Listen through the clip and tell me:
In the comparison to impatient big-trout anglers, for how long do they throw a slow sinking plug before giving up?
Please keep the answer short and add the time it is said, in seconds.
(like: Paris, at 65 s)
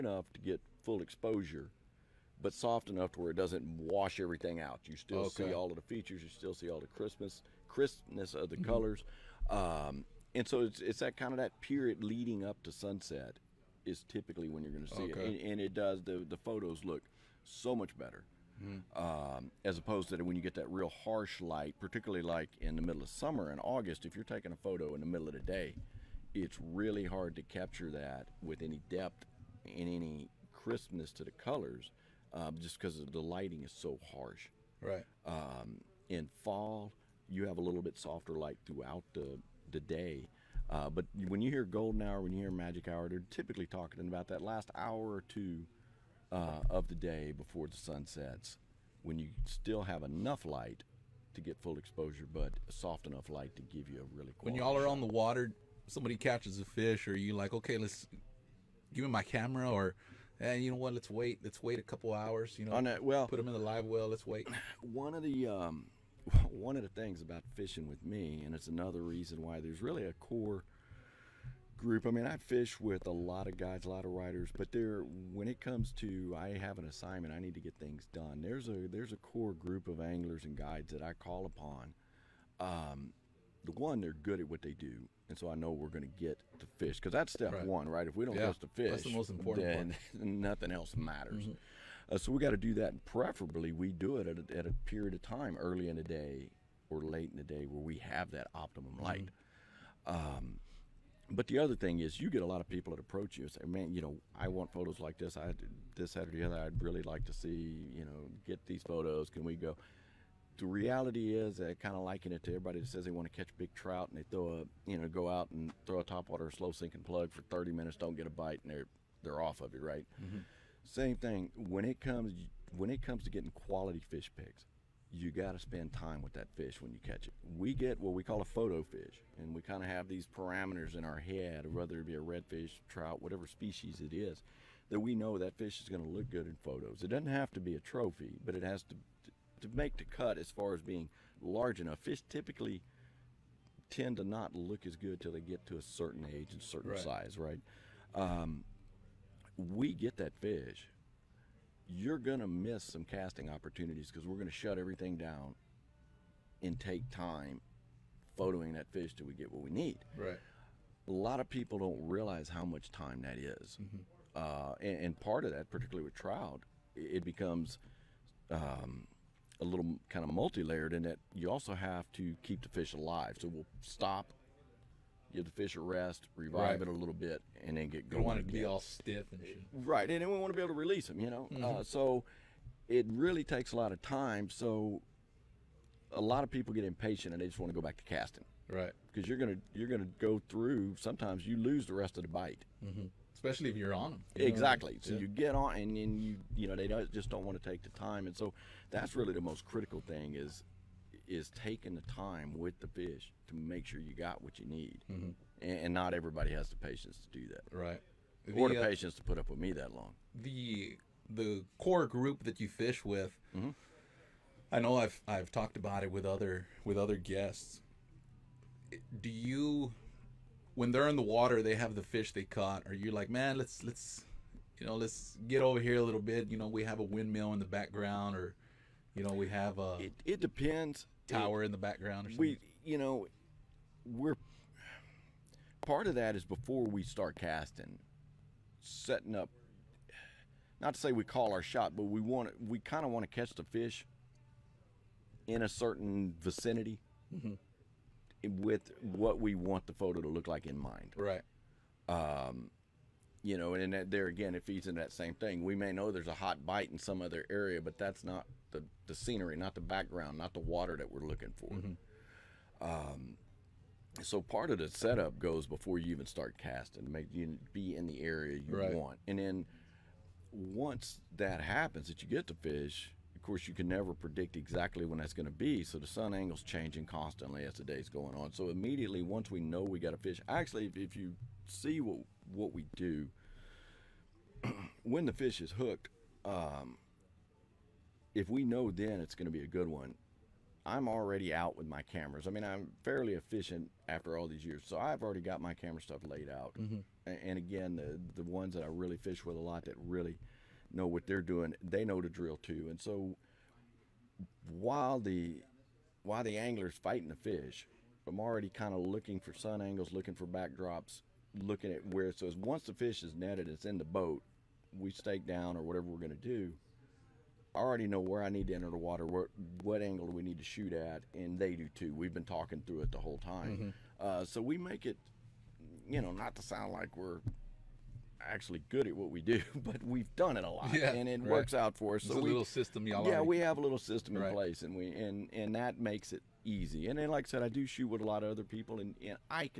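30 minutes, at 117 s.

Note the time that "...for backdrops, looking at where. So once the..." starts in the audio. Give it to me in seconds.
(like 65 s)
310 s.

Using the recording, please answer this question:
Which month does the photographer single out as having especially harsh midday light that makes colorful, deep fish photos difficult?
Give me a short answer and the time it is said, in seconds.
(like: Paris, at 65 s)
August, at 23 s.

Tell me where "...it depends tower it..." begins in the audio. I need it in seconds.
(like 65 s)
230 s.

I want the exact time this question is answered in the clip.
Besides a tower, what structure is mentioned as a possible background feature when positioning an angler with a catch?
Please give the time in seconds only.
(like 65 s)
227 s.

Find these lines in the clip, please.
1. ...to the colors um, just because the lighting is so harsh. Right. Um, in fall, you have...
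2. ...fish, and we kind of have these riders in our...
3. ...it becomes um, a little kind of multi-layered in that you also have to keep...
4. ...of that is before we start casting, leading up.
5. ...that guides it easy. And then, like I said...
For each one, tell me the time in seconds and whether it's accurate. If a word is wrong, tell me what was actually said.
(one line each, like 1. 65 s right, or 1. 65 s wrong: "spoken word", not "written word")
1. 31 s right
2. 128 s wrong: "parameters", not "riders"
3. 166 s right
4. 236 s wrong: "setting", not "leading"
5. 335 s wrong: "makes", not "guides".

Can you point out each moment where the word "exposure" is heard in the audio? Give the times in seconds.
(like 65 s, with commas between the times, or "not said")
1 s, 51 s.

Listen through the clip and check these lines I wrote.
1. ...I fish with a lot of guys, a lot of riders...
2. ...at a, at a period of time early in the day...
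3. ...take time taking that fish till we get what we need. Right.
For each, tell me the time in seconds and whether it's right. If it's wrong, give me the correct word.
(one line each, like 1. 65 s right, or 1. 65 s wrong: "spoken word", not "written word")
1. 72 s right
2. 94 s right
3. 156 s wrong: "photoing", not "taking".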